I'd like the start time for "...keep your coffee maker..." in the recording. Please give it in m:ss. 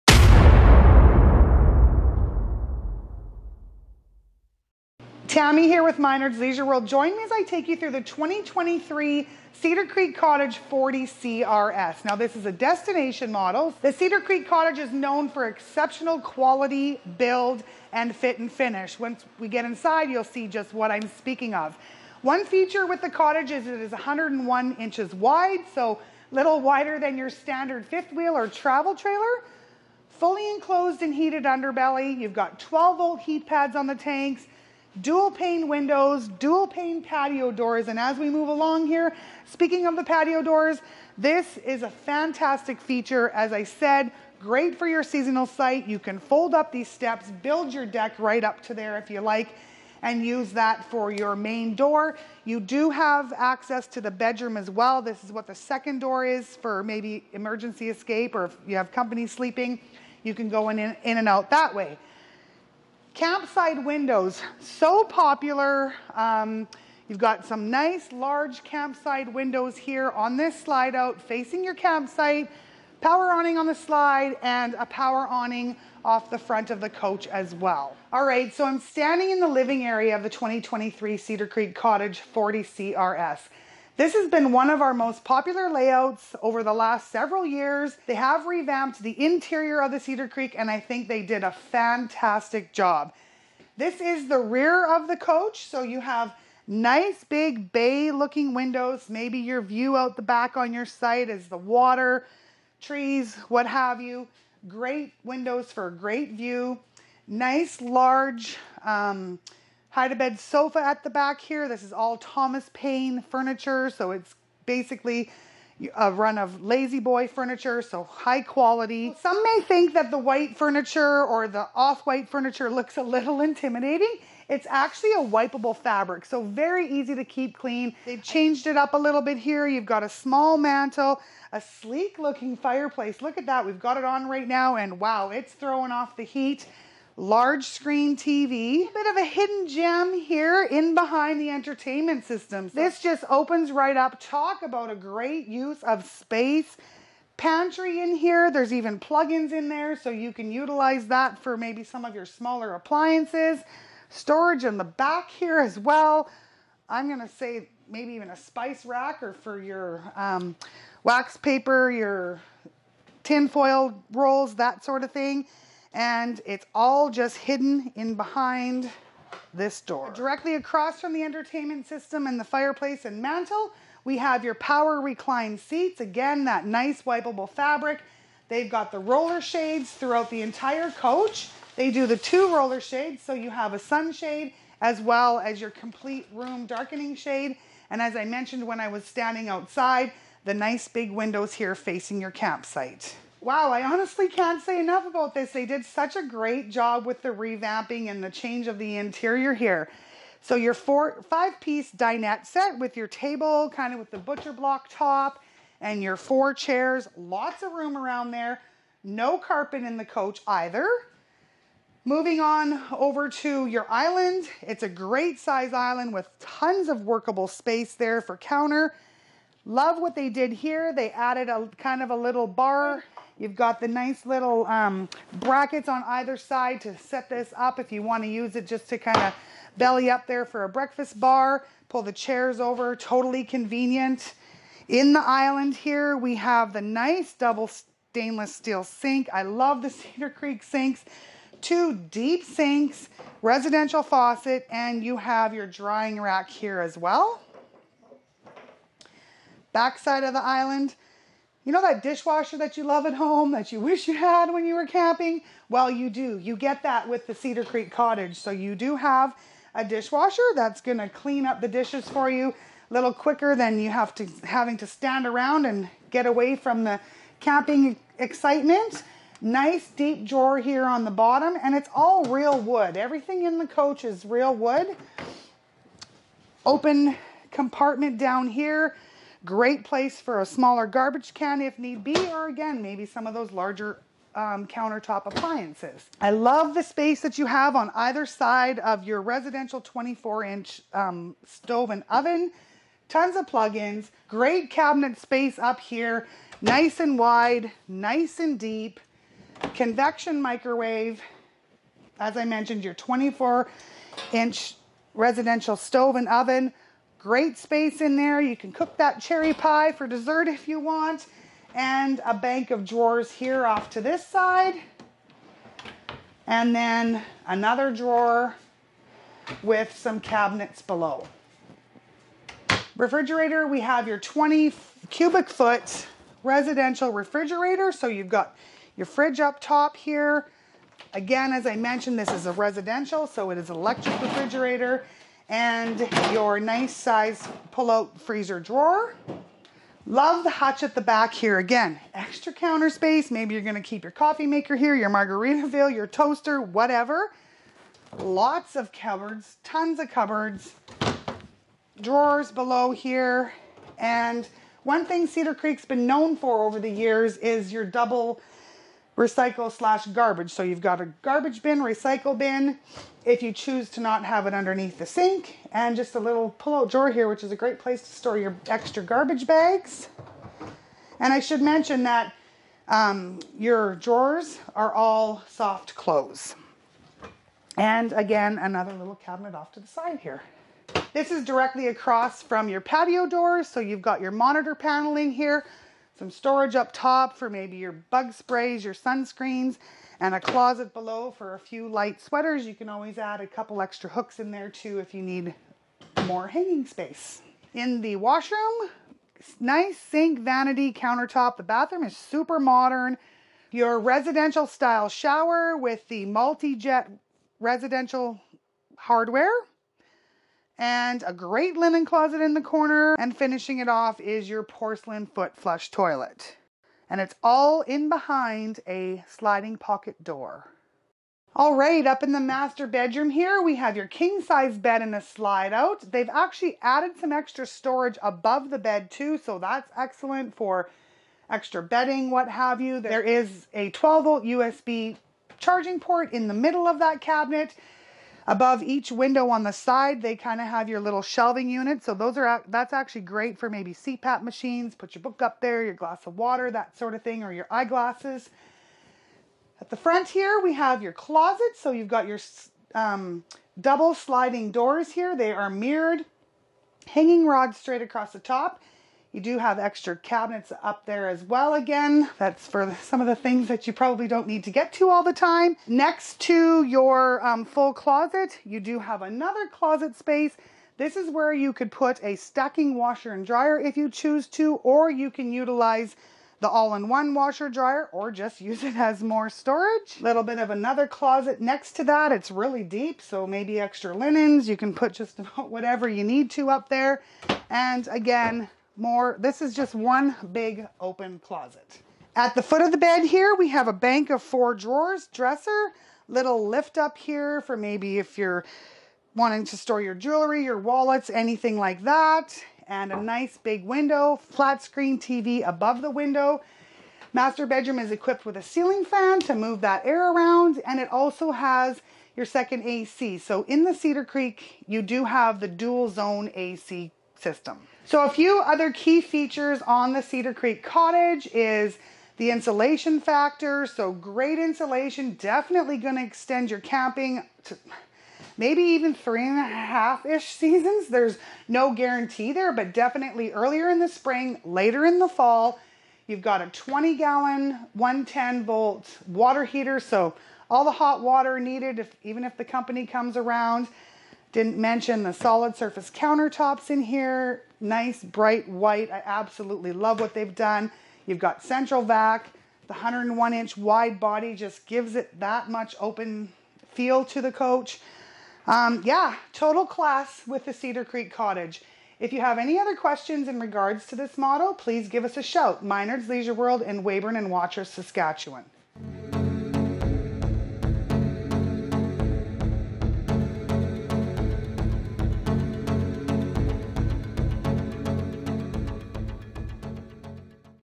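5:43.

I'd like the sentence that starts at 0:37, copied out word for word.
And as we move along here, speaking of the patio doors, this is a fantastic feature.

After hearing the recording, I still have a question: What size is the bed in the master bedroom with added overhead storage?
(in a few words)
king size.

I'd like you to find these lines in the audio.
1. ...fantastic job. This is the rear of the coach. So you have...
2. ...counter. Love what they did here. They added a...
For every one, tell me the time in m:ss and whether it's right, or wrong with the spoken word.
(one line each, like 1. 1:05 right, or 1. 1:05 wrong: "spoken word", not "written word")
1. 1:31 right
2. 3:38 right.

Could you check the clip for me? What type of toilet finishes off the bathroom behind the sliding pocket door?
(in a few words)
porcelain foot flush.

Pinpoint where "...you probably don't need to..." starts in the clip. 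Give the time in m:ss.
7:43.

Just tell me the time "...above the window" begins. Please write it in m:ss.
8:25.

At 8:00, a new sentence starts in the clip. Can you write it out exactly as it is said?
Little bit of another closet next to that.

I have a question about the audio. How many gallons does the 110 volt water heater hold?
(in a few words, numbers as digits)
20 gallons.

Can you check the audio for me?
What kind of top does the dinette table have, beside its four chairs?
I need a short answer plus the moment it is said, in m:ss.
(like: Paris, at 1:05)
butcher block, at 3:24.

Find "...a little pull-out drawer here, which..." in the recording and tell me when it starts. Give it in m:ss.
6:06.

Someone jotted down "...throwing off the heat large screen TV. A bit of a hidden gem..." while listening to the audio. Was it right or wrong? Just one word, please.
right.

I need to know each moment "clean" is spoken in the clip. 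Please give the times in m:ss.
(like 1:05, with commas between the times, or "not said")
2:07, 4:21.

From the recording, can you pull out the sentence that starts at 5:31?
Again, as I mentioned, this is a residential, so it is electric refrigerator and your nice size pull-out freezer drawer.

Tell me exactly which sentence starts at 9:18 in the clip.
Um, yeah, total class with the Cedar Creek Cottage.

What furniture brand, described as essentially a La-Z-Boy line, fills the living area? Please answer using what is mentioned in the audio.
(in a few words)
Thomas Payne.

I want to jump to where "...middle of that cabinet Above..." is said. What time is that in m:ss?
7:16.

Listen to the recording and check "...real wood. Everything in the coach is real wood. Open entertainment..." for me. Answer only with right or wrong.
wrong.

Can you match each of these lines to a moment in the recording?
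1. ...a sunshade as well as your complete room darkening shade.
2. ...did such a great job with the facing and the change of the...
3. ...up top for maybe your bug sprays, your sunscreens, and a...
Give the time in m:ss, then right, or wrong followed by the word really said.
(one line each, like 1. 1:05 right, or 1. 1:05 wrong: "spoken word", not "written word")
1. 3:03 right
2. 3:15 wrong: "revamping", not "facing"
3. 6:26 right.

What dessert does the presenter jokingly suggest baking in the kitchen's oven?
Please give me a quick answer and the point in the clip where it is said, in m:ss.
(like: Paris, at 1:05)
cherry pie, at 5:09.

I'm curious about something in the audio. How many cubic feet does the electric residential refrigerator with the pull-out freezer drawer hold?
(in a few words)
20 cubic foot.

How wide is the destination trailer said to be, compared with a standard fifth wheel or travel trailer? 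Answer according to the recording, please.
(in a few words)
101 inches.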